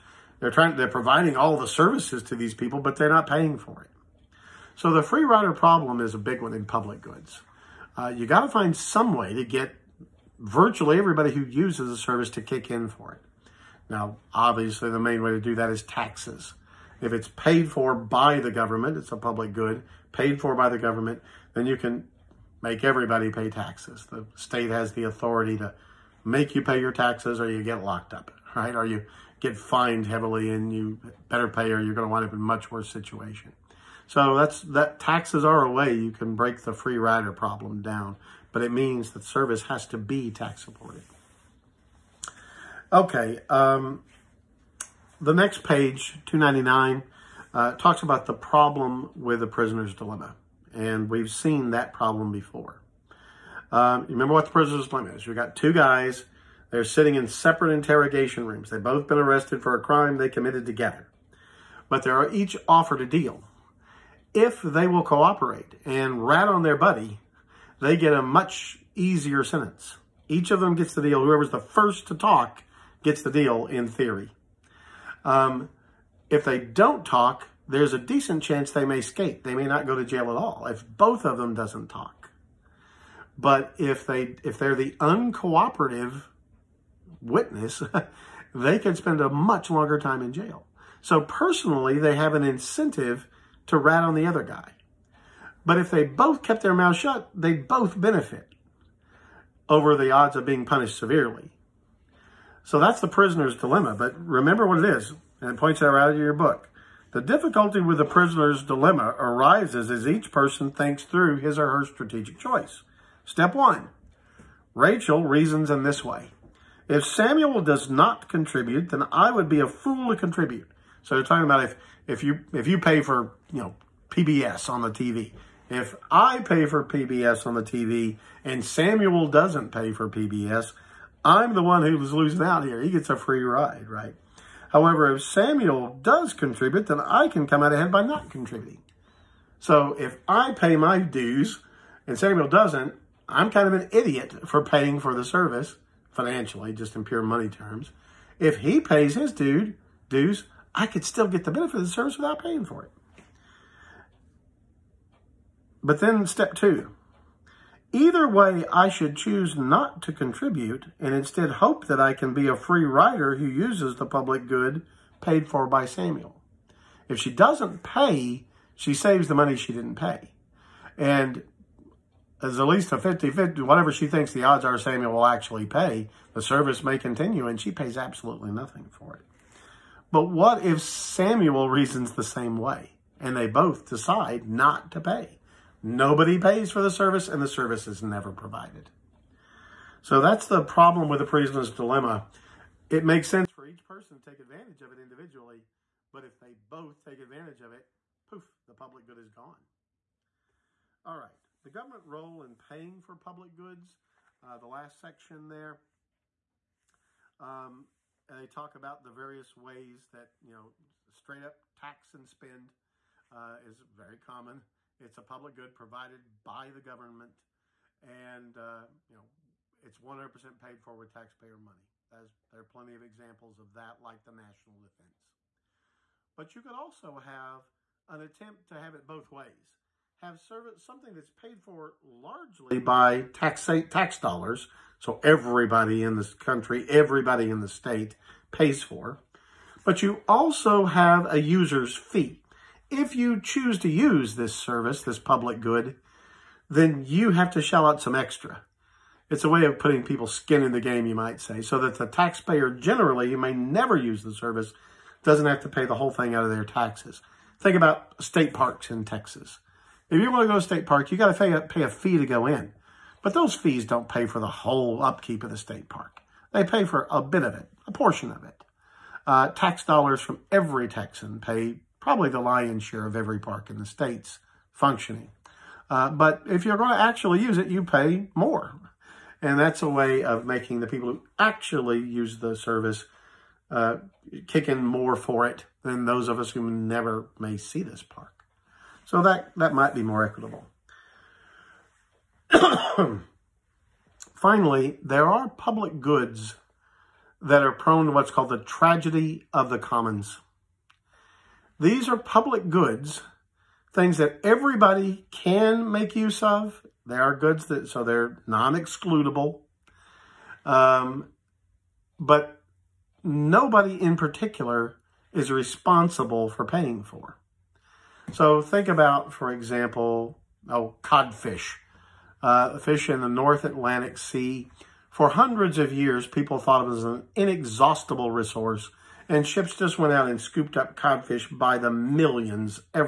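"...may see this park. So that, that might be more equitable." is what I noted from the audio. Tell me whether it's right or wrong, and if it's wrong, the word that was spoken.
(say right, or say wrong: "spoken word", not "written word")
right.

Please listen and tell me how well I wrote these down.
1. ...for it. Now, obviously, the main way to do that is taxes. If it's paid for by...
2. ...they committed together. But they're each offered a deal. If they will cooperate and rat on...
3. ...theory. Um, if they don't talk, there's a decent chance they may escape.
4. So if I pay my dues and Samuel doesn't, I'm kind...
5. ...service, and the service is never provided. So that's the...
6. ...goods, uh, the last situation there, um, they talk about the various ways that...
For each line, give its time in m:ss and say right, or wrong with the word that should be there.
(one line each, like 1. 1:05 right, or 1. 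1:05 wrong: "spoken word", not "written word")
1. 0:12 right
2. 1:00 right
3. 1:13 right
4. 2:19 right
5. 3:06 right
6. 3:23 wrong: "section", not "situation".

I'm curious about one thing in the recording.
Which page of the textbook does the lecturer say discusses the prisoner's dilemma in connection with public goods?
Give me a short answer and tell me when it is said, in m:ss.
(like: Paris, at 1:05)
299, at 0:46.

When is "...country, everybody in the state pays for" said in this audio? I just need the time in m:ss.
3:56.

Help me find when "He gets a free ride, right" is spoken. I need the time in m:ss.
2:12.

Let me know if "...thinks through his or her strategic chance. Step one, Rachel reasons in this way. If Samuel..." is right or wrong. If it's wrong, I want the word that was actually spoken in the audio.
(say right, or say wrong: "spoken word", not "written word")
wrong: "choice", not "chance".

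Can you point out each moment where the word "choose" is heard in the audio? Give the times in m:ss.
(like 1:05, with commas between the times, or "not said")
2:39, 4:03.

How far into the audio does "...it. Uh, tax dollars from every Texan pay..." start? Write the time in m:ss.
4:28.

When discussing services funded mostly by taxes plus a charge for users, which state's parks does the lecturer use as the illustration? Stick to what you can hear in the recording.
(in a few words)
Texas.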